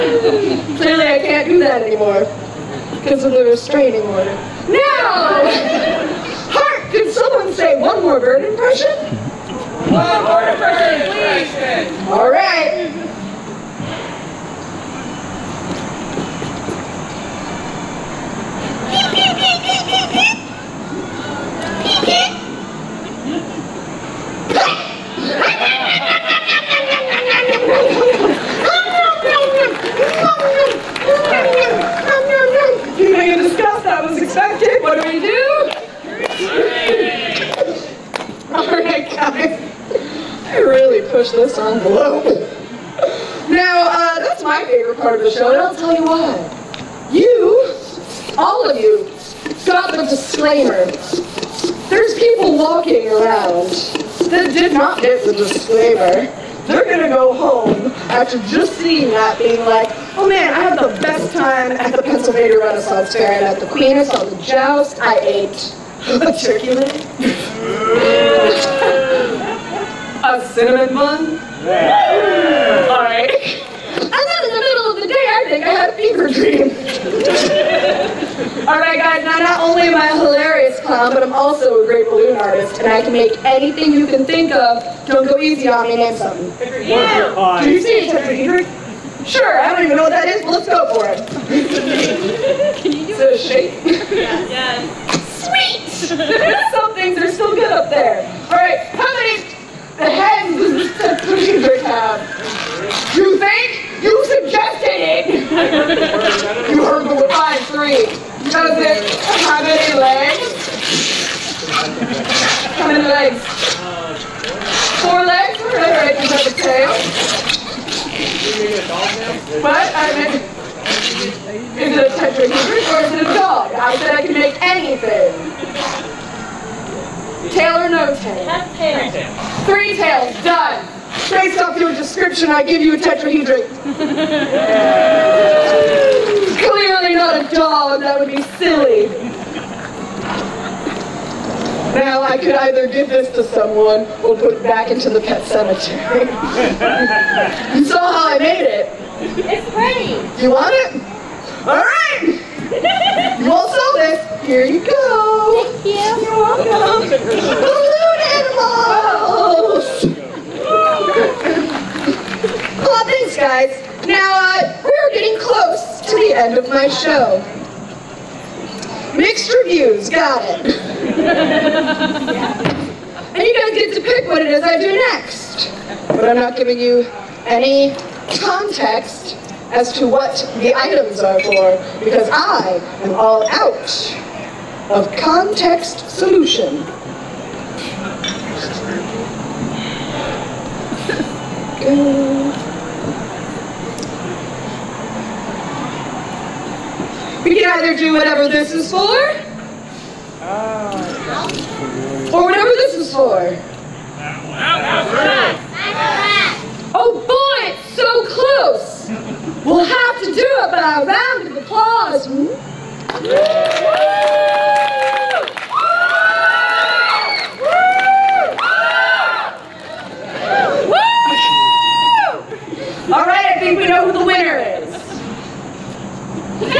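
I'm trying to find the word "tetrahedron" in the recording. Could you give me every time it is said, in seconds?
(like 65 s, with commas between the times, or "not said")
88 s, 122 s, 132 s.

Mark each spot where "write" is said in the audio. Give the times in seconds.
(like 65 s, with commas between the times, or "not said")
115 s.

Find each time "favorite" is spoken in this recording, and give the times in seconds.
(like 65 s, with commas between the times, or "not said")
44 s.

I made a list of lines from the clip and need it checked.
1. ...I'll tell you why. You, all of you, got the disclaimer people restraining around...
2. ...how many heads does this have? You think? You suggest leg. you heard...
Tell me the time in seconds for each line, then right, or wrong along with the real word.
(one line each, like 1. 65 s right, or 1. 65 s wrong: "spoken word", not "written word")
1. 45 s wrong: "walking", not "restraining"
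2. 98 s right.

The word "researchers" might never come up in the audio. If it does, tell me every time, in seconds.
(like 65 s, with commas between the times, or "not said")
not said.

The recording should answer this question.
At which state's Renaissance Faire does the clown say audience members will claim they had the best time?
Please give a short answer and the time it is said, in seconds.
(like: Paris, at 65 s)
Pennsylvania, at 62 s.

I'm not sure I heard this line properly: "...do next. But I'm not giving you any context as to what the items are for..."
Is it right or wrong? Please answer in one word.
right.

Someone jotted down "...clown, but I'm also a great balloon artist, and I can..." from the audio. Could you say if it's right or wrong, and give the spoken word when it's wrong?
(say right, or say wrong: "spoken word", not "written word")
right.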